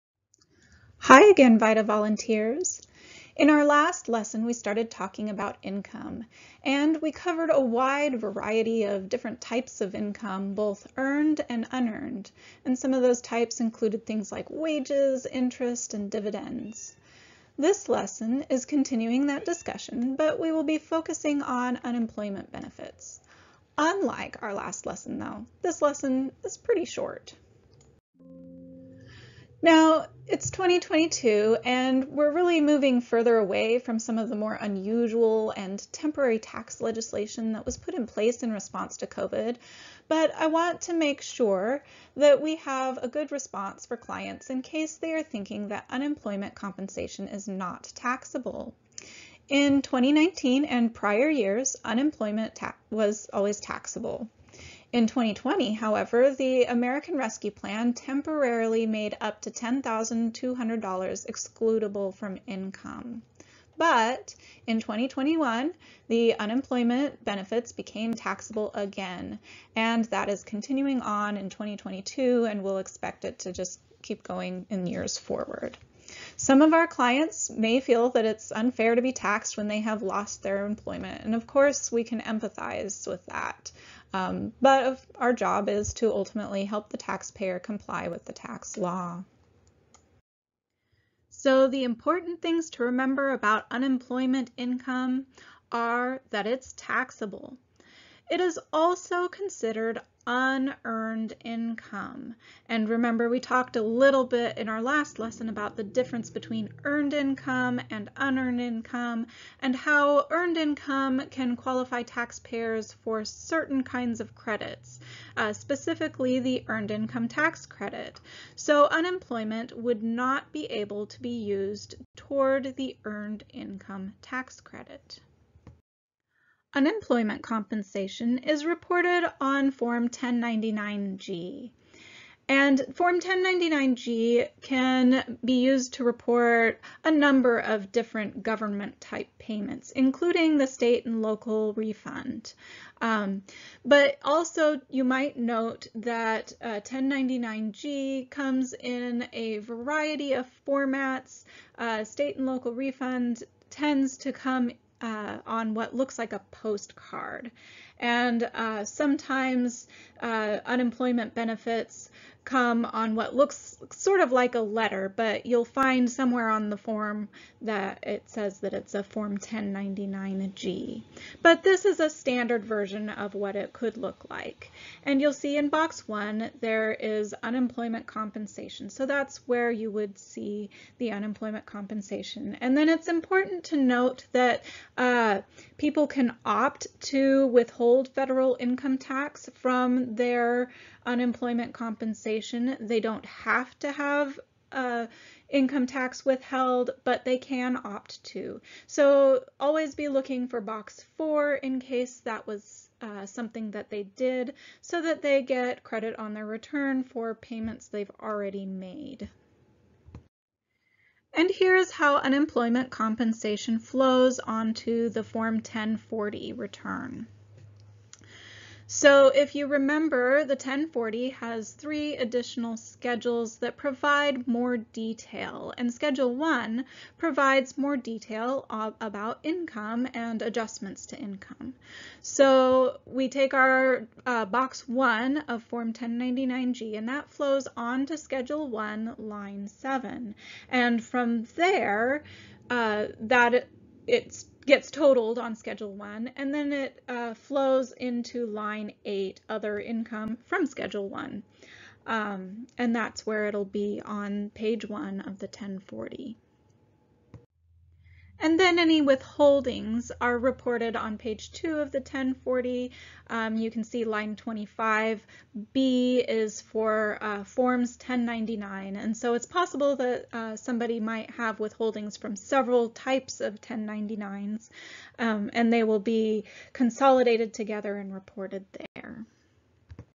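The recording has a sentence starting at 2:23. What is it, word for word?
Um, but also you might note that uh, 1099-G comes in a variety of formats.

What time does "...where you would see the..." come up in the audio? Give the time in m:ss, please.
2:59.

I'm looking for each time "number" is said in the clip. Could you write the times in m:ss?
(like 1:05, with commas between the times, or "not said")
2:17.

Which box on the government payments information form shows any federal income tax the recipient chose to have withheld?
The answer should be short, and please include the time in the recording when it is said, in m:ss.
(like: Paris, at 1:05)
box four, at 3:20.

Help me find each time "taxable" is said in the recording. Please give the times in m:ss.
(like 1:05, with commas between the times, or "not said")
0:47, 0:53, 1:08, 1:36.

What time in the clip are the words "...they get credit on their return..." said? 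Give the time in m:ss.
3:25.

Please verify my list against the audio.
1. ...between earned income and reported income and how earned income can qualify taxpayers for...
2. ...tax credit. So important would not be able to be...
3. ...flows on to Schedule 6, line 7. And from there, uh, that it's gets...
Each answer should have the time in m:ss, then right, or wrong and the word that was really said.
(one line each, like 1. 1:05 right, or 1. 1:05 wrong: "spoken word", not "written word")
1. 1:46 wrong: "unearned", not "reported"
2. 1:57 wrong: "unemployment", not "important"
3. 3:57 wrong: "1", not "6".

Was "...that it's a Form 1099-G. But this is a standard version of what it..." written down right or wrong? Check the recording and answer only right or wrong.
right.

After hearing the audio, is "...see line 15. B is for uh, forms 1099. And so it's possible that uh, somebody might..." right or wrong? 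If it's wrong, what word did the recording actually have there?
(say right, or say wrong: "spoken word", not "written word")
wrong: "25", not "15".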